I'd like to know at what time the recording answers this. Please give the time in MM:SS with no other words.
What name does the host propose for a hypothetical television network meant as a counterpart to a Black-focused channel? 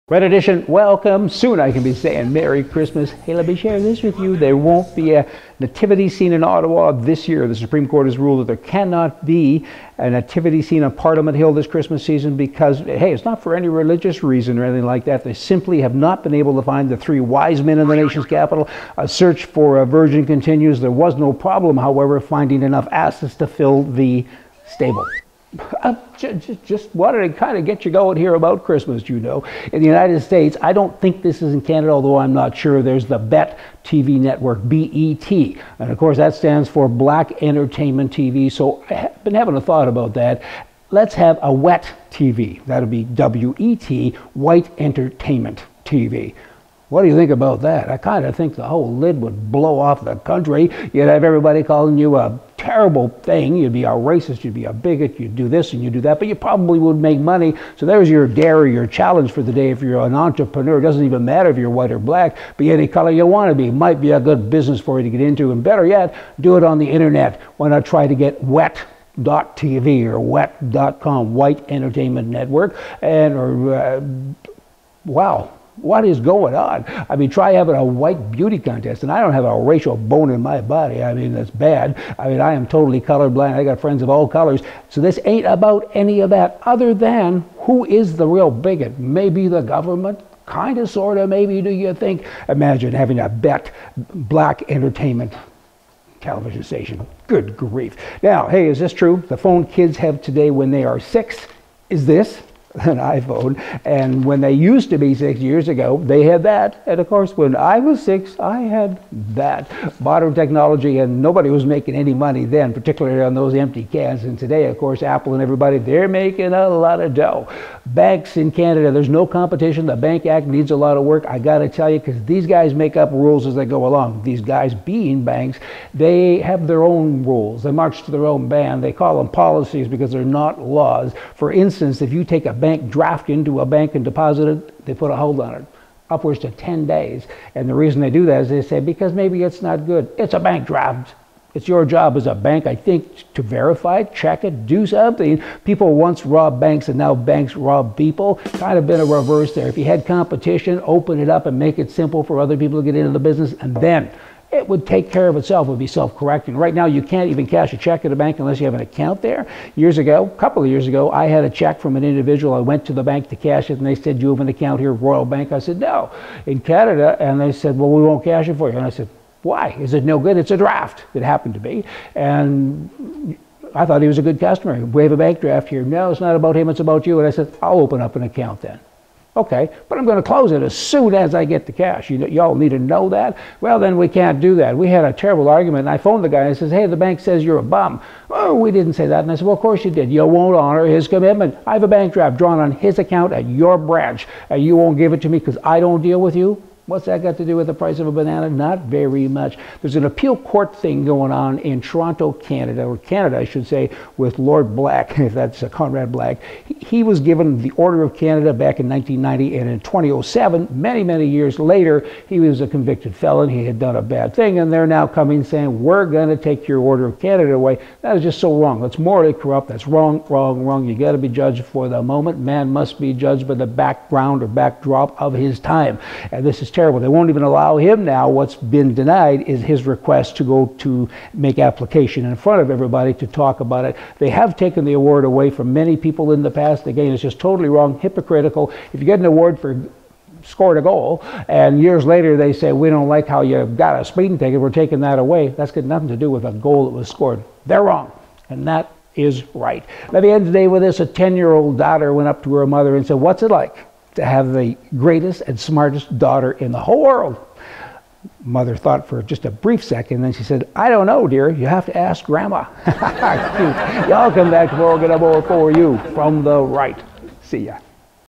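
00:44.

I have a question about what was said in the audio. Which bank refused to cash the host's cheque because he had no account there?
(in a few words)
Royal Bank.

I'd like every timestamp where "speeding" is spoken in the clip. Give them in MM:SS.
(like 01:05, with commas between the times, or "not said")
04:04.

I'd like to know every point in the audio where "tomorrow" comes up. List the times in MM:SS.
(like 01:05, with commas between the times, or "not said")
04:24.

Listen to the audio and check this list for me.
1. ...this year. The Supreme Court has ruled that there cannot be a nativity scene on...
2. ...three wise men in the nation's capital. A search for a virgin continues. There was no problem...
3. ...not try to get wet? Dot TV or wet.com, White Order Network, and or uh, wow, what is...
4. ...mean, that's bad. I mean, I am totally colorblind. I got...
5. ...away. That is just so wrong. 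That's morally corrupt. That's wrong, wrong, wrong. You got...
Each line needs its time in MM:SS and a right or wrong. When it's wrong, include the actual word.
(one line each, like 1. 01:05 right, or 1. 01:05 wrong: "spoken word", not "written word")
1. 00:06 right
2. 00:16 right
3. 01:07 wrong: "Entertainment", not "Order"
4. 01:21 right
5. 03:37 right.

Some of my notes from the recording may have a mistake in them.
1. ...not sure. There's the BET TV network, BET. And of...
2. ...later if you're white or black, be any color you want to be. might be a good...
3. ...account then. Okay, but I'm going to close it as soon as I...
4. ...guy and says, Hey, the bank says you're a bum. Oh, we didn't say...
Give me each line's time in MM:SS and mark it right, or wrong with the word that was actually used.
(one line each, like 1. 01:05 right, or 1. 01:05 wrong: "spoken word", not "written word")
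1. 00:32 right
2. 01:01 wrong: "matter", not "later"
3. 02:58 right
4. 03:06 right.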